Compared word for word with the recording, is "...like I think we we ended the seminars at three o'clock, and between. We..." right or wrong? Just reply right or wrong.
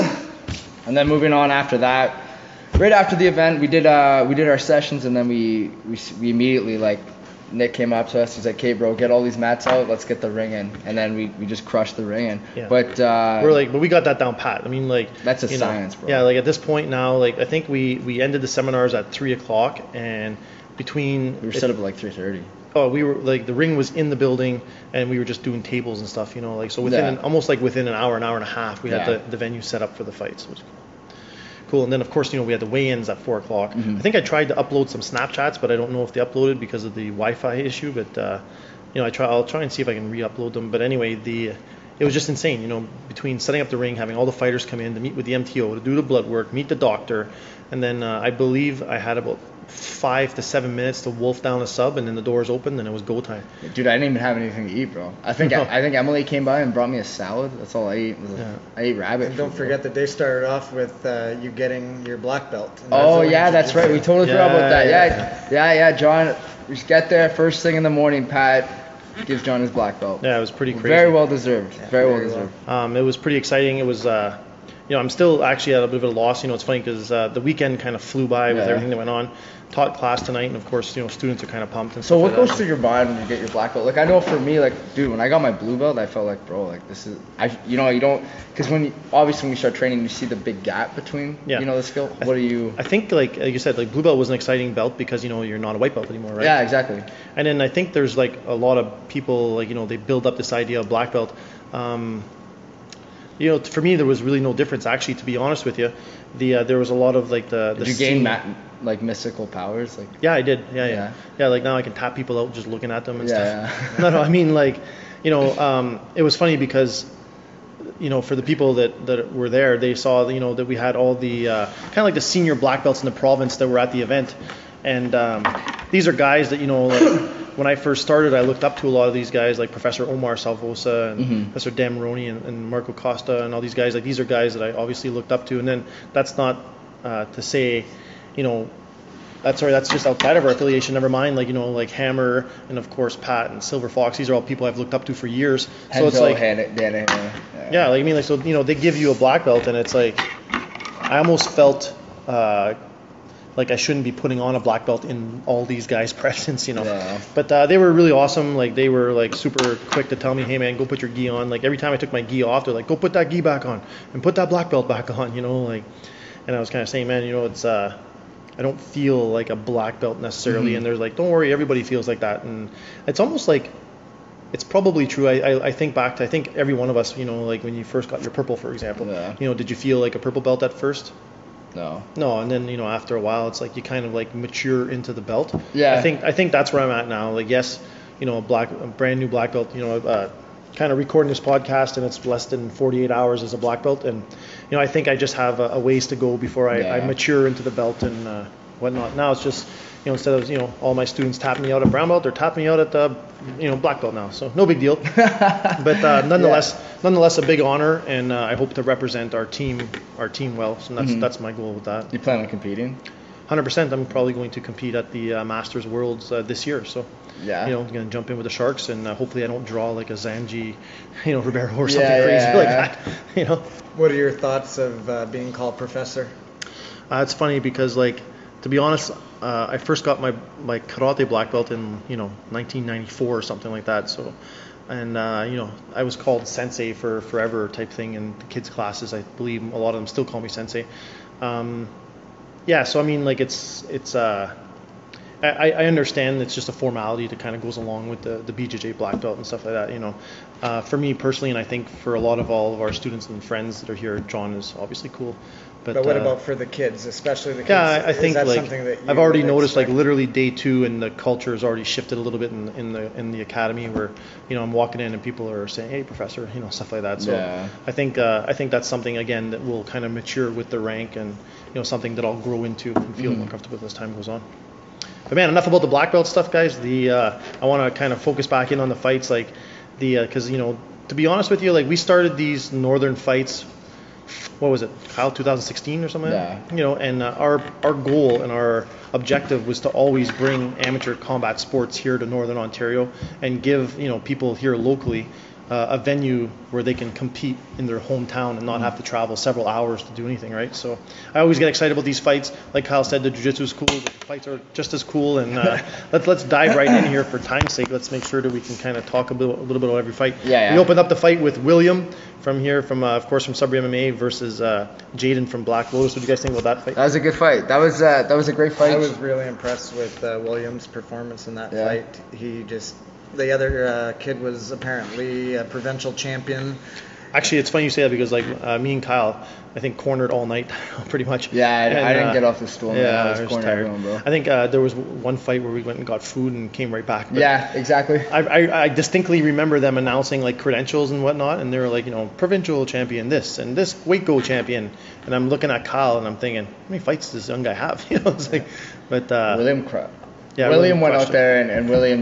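right.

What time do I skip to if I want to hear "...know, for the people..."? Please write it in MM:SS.
01:58.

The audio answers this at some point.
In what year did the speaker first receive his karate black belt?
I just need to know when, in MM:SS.
03:52.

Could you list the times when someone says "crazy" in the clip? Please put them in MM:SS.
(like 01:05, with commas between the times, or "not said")
01:10, 03:42.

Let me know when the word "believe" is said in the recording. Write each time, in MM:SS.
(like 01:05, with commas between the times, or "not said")
00:48, 03:59.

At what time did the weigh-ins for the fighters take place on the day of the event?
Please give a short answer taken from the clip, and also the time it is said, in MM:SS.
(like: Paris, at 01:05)
4 o'clock, at 00:33.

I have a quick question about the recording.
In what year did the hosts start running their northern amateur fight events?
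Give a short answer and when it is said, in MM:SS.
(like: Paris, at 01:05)
2016, at 04:45.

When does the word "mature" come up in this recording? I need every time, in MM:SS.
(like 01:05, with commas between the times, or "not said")
03:04, 03:17, 04:30.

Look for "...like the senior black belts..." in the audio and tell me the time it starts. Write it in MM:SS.
02:02.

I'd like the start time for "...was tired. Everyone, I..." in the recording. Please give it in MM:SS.
05:33.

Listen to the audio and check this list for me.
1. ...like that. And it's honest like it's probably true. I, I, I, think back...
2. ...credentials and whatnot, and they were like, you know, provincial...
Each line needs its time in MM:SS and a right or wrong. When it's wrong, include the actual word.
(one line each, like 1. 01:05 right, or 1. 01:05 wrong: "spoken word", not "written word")
1. 02:52 wrong: "almost", not "honest"
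2. 05:40 right.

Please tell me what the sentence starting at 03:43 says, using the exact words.
What are your thoughts of uh, being called professor?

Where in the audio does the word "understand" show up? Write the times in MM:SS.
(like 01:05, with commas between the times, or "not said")
04:05.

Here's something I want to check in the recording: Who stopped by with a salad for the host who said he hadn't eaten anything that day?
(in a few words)
Emily.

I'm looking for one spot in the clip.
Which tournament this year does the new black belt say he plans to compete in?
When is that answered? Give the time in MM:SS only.
03:35.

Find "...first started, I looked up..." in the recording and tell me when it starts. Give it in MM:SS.
02:07.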